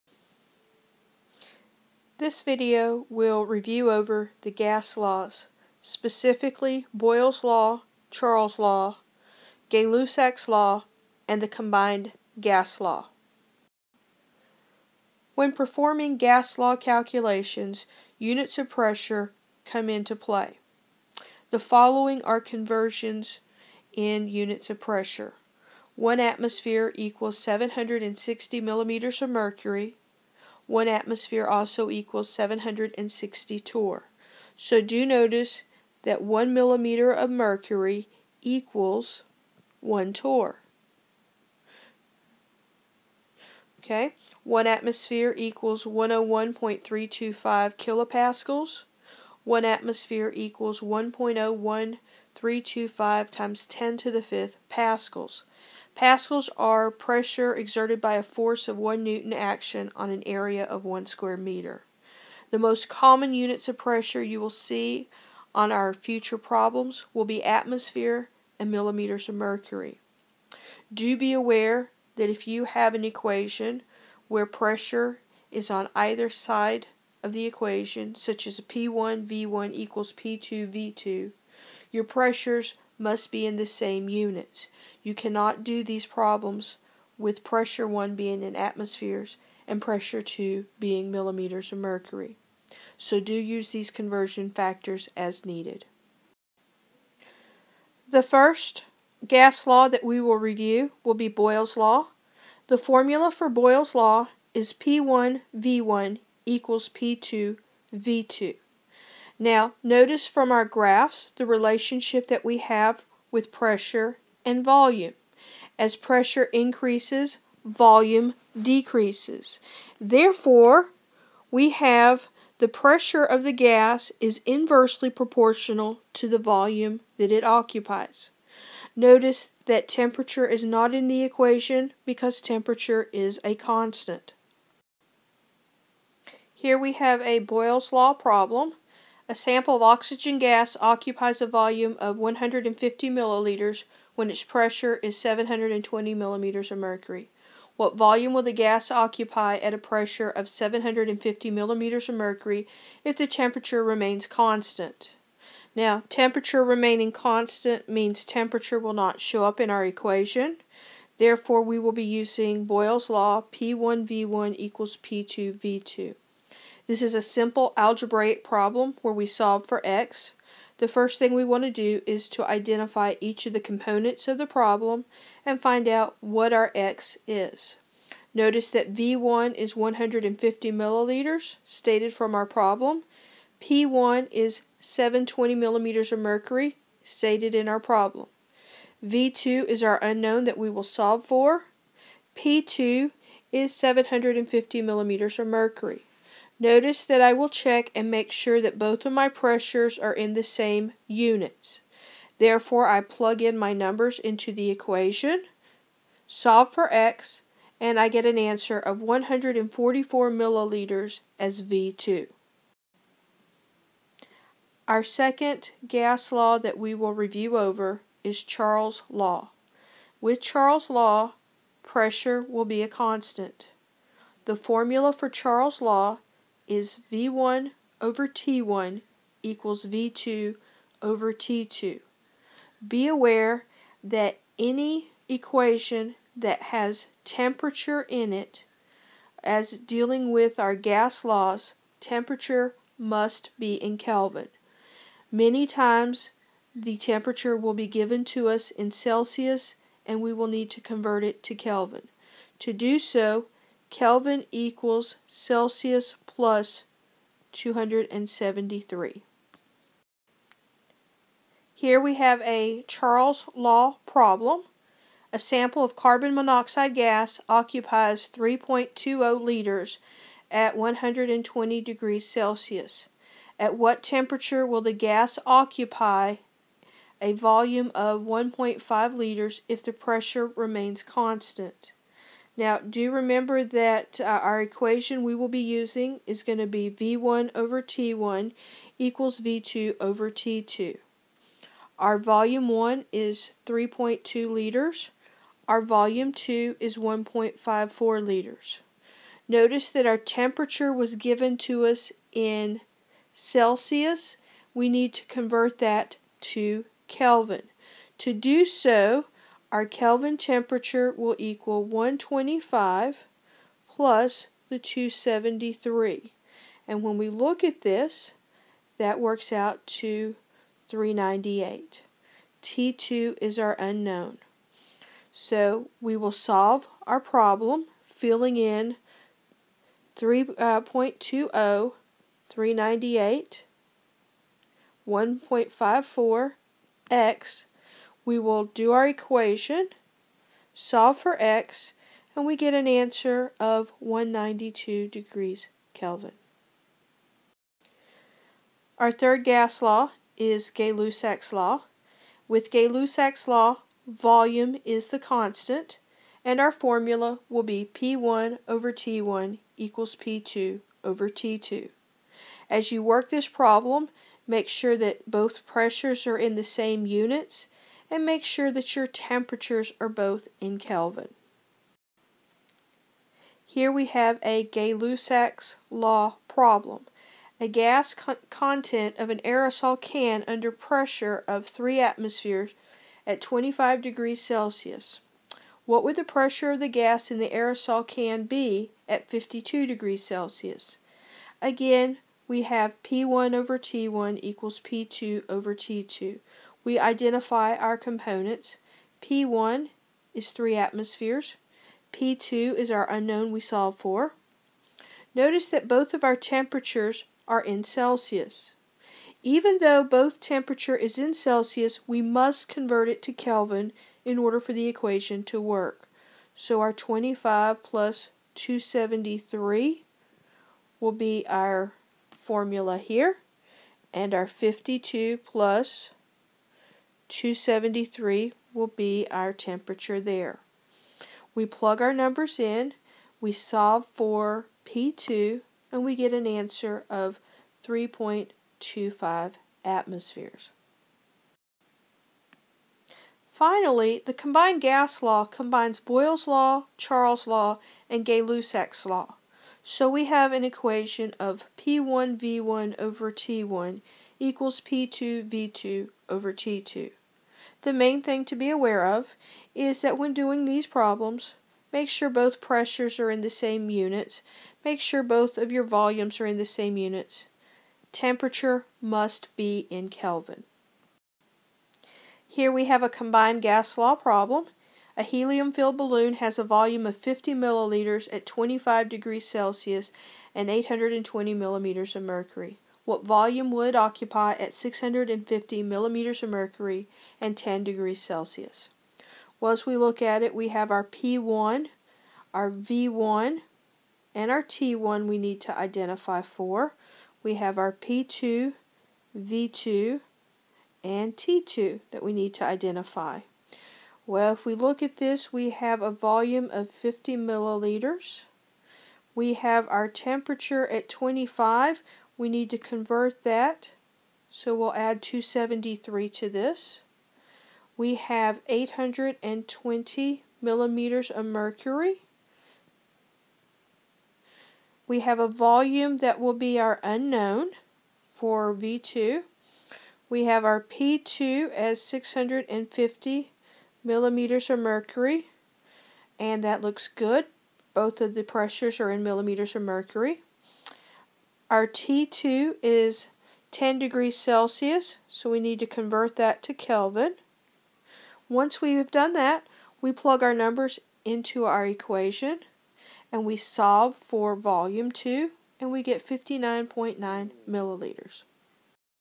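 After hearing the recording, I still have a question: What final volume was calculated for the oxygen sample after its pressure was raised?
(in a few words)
144 milliliters.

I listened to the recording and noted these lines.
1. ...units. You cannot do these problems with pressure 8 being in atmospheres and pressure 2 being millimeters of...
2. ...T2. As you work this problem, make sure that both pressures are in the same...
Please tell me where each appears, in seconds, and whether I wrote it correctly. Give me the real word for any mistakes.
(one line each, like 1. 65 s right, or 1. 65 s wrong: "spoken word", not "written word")
1. 84 s wrong: "1", not "8"
2. 361 s right.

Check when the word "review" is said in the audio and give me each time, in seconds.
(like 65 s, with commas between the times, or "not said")
3 s, 100 s, 217 s.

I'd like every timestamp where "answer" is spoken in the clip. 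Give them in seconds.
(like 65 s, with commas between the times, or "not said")
208 s, 342 s, 436 s.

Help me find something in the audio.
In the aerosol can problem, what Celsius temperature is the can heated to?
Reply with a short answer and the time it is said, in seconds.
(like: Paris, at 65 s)
52 degrees Celsius, at 389 s.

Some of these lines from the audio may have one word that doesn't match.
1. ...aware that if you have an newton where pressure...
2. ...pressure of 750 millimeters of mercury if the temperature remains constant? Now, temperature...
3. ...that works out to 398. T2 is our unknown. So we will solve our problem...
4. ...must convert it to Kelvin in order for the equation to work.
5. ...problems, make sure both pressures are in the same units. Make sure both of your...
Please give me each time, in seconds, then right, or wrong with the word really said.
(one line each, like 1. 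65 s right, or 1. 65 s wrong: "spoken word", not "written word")
1. 71 s wrong: "equation", not "newton"
2. 149 s right
3. 318 s right
4. 412 s right
5. 460 s right.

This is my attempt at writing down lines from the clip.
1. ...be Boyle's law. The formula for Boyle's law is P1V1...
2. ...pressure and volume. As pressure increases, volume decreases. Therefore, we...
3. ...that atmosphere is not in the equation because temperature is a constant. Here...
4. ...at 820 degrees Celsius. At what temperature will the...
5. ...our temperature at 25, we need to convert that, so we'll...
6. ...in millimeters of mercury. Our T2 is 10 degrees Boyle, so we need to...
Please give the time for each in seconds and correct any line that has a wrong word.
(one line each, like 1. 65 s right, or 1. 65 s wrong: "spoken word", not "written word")
1. 101 s right
2. 113 s right
3. 129 s wrong: "temperature", not "atmosphere"
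4. 270 s wrong: "120", not "820"
5. 509 s right
6. 539 s wrong: "Celsius", not "Boyle".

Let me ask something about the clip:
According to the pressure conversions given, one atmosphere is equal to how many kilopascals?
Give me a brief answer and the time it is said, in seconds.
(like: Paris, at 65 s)
101.325 kilopascals, at 45 s.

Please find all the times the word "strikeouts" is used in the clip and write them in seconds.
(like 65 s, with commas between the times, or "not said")
not said.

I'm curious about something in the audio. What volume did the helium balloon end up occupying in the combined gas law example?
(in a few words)
59.9 milliliters.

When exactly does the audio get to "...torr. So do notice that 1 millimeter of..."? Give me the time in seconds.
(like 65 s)
33 s.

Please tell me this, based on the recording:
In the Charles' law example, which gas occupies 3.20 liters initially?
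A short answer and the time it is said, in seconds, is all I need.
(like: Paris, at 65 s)
carbon monoxide, at 265 s.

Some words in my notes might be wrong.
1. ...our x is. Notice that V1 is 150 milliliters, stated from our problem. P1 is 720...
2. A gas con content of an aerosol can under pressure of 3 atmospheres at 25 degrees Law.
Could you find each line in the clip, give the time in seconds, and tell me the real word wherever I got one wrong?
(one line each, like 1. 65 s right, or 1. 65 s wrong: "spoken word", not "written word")
1. 176 s right
2. 377 s wrong: "Celsius", not "Law".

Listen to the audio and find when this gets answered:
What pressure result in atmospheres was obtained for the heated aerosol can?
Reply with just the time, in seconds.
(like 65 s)
437 s.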